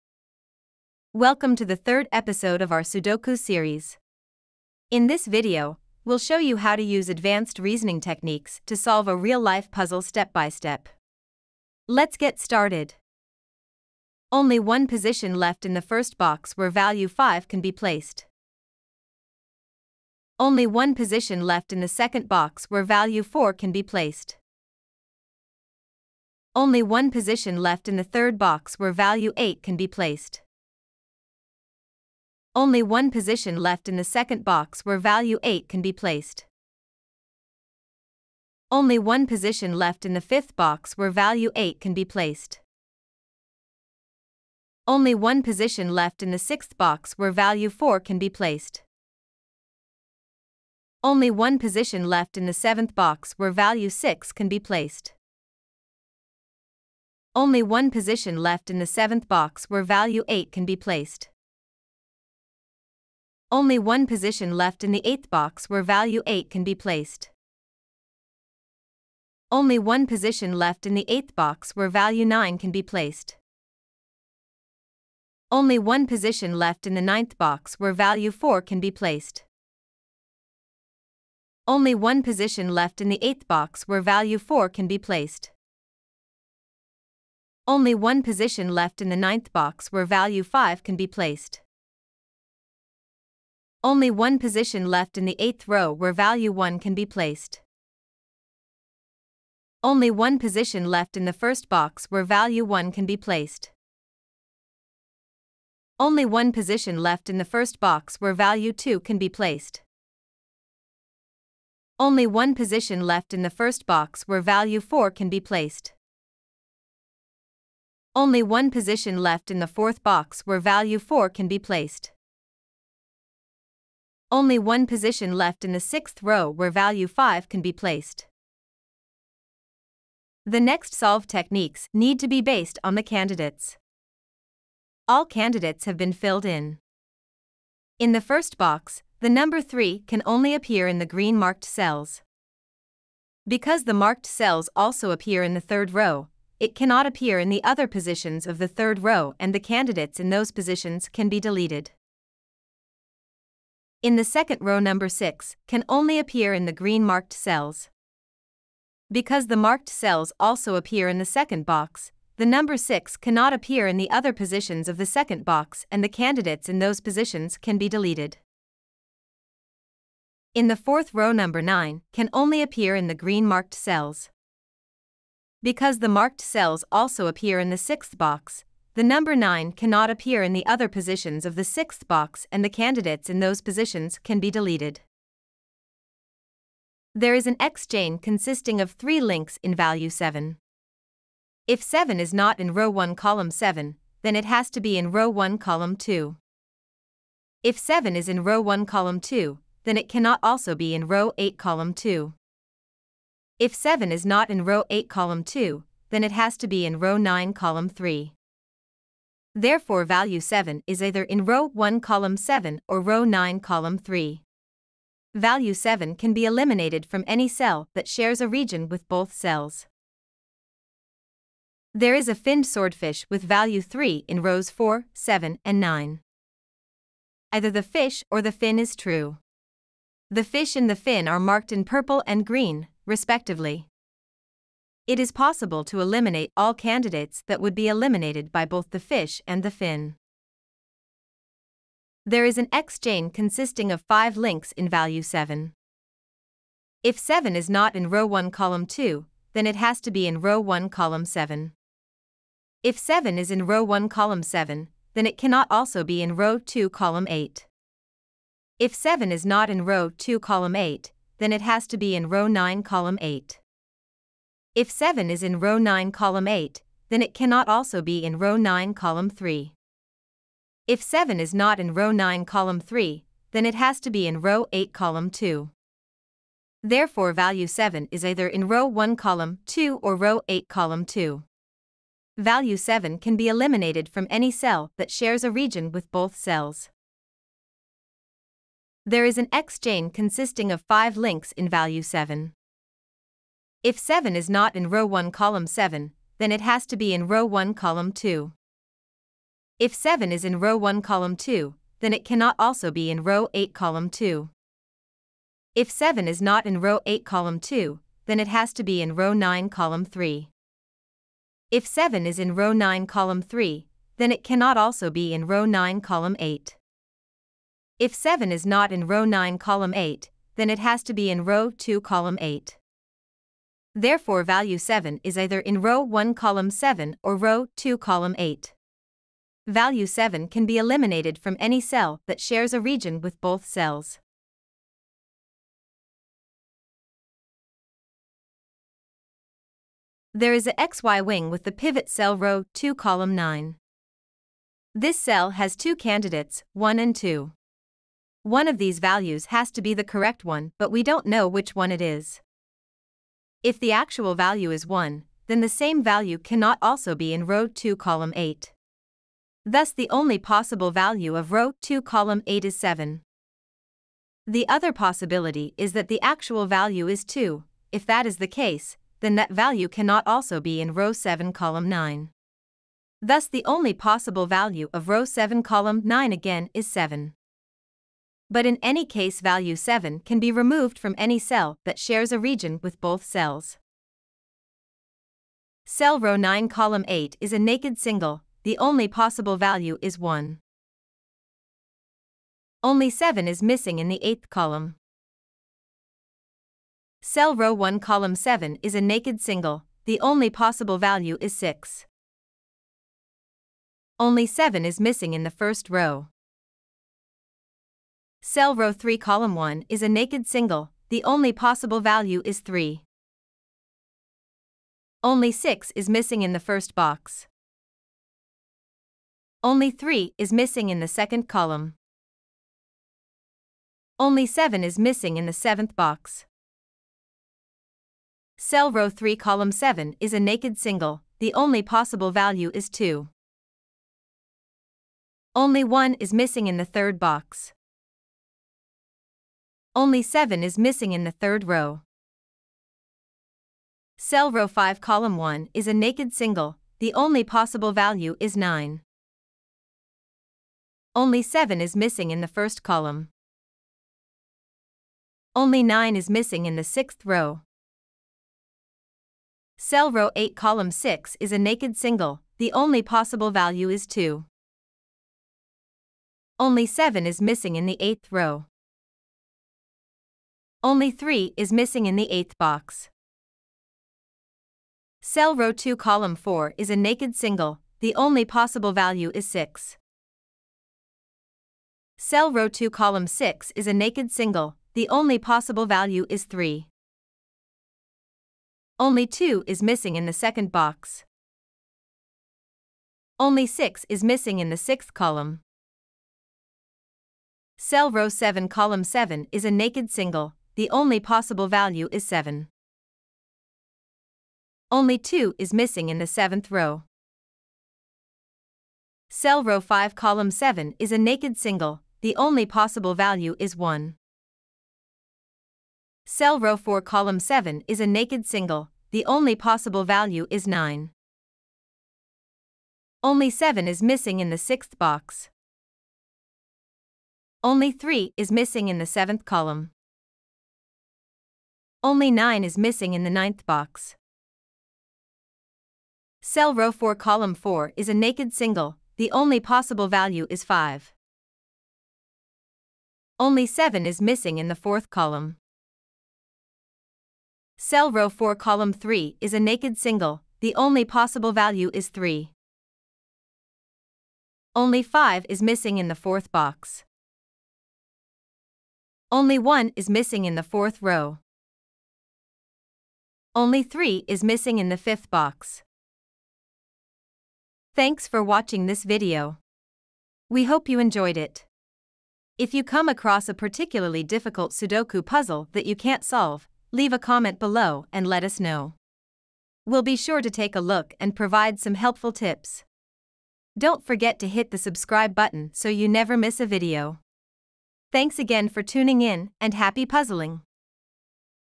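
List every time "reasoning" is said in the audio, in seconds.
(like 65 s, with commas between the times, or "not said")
7 s.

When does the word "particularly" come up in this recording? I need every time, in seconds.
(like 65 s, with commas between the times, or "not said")
573 s.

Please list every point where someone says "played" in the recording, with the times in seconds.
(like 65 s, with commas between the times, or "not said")
not said.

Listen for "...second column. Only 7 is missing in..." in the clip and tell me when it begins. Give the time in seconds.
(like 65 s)
421 s.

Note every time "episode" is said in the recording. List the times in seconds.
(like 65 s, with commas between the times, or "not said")
2 s.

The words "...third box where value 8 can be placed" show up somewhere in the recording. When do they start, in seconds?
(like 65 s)
28 s.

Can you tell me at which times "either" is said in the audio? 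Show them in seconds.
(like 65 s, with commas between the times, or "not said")
211 s, 227 s, 278 s, 325 s.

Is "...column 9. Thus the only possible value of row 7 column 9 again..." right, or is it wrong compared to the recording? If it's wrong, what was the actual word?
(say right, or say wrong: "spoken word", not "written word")
right.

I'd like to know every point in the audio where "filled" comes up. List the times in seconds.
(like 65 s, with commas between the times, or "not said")
136 s.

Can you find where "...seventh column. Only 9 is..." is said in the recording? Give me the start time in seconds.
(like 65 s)
529 s.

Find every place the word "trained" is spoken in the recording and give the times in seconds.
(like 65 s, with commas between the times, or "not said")
not said.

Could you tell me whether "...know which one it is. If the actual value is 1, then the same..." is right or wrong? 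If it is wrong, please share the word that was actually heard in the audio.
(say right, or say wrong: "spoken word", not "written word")
right.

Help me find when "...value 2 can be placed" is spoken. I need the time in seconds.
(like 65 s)
108 s.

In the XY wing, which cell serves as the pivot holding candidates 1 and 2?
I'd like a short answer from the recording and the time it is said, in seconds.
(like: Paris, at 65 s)
row 2 column 9, at 342 s.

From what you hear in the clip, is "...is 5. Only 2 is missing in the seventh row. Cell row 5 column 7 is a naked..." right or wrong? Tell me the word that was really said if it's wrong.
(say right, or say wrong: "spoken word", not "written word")
wrong: "7", not "5".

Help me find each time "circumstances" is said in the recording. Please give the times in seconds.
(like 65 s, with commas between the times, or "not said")
not said.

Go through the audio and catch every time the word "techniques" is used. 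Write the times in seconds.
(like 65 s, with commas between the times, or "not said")
7 s, 131 s.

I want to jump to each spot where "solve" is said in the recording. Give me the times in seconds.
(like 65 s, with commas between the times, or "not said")
8 s, 130 s, 576 s.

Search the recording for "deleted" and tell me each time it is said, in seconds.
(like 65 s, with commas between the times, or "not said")
151 s, 167 s, 184 s.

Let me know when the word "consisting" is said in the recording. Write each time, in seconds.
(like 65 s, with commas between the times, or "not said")
188 s, 243 s, 290 s.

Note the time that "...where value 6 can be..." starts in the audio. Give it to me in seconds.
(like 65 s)
53 s.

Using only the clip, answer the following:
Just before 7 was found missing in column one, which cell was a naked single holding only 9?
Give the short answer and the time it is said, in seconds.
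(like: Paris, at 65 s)
row 5 column 1, at 444 s.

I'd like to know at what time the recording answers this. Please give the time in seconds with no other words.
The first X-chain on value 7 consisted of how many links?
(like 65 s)
188 s.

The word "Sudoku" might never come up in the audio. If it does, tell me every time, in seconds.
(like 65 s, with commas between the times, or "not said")
2 s, 574 s.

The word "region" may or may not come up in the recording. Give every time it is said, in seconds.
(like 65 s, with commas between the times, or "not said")
218 s, 285 s, 332 s, 382 s.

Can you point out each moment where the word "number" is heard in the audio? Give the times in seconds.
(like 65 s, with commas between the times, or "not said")
139 s, 154 s, 162 s, 171 s, 179 s.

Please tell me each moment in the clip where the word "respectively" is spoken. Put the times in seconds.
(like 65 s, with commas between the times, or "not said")
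233 s.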